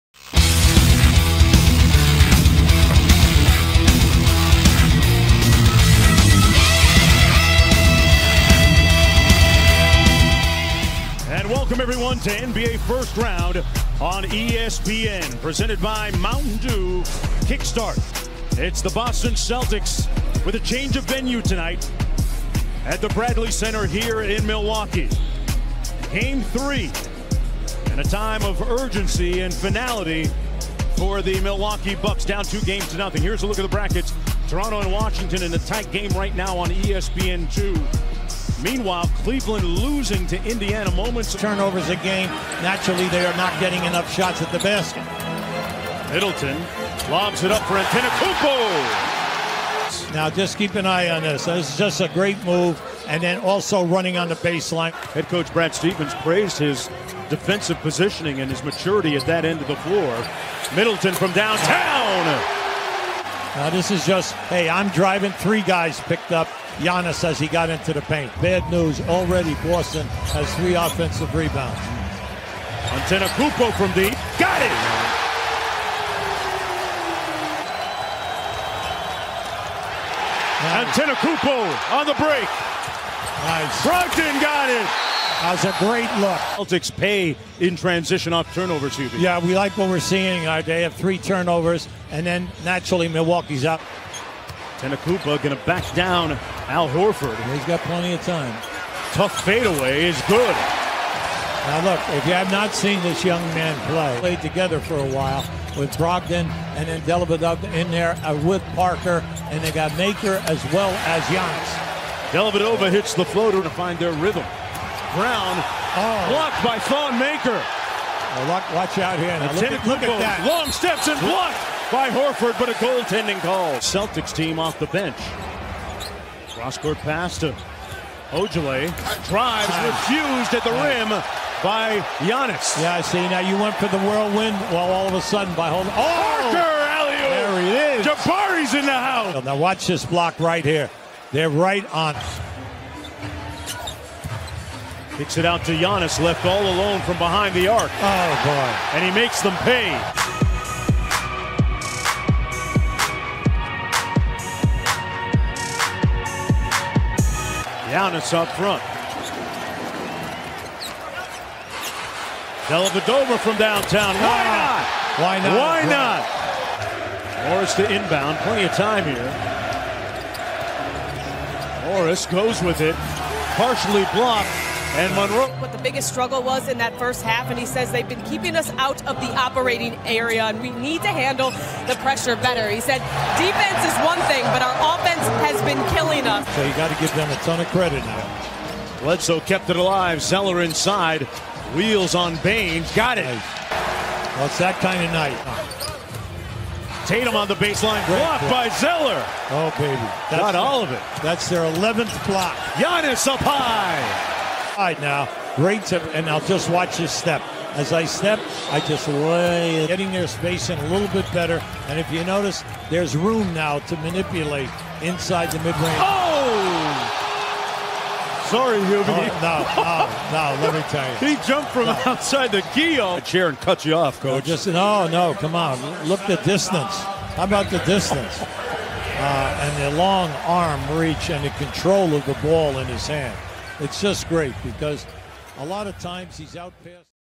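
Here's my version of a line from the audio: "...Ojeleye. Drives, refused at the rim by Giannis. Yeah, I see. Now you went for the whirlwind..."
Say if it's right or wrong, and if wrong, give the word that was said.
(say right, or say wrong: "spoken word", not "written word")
right.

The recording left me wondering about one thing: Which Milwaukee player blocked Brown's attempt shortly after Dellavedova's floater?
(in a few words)
Thon Maker.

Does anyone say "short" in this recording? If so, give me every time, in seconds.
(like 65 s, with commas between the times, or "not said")
not said.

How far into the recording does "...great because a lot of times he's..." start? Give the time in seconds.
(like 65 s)
234 s.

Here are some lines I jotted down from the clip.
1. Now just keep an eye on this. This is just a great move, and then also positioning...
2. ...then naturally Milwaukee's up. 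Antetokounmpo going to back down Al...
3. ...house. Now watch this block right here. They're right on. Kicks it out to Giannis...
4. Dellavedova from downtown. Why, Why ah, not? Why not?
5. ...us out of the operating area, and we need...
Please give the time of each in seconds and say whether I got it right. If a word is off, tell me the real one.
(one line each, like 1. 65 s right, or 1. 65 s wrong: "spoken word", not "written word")
1. 50 s wrong: "running", not "positioning"
2. 92 s right
3. 138 s right
4. 162 s right
5. 178 s right.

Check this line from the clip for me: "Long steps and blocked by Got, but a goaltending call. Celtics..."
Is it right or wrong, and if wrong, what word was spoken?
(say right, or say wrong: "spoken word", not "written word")
wrong: "Horford", not "Got".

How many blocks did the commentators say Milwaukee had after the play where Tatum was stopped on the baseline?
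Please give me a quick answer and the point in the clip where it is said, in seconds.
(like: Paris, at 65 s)
11, at 201 s.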